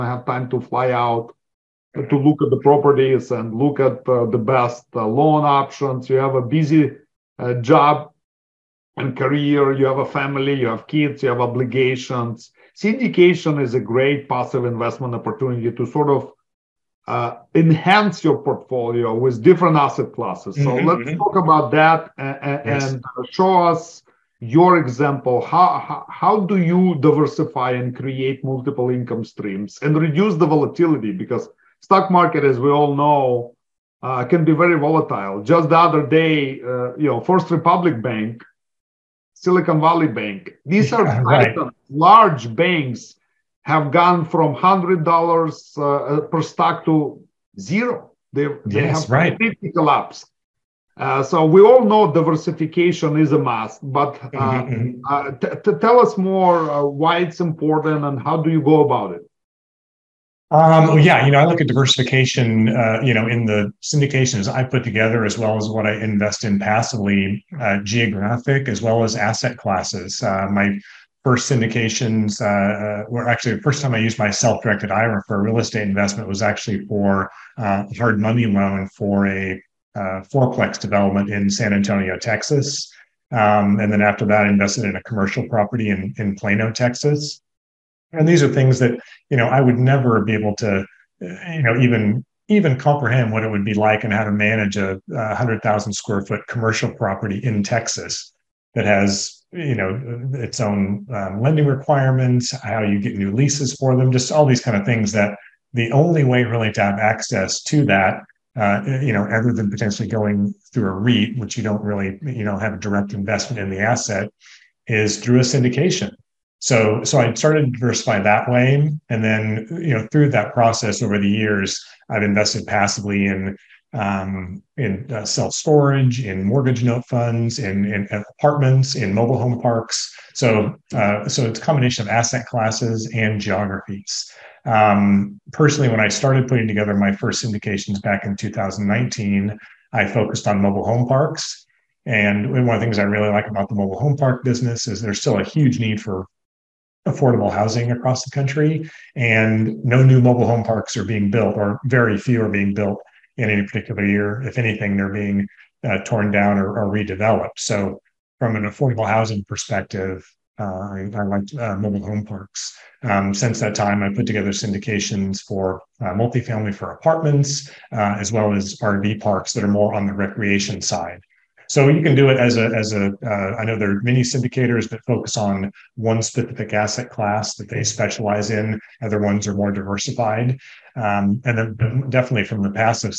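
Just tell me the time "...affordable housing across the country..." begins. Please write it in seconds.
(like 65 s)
147 s.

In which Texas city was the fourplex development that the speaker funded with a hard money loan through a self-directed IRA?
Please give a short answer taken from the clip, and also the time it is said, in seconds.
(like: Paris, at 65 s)
San Antonio, at 81 s.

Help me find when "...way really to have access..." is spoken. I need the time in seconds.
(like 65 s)
106 s.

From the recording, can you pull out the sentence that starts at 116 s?
So, so I started to diversify that way.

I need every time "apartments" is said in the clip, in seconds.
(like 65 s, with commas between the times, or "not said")
128 s, 166 s.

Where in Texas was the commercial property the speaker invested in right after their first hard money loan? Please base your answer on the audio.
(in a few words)
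Plano.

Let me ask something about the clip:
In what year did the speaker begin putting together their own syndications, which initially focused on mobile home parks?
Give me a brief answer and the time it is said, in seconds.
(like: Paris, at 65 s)
2019, at 138 s.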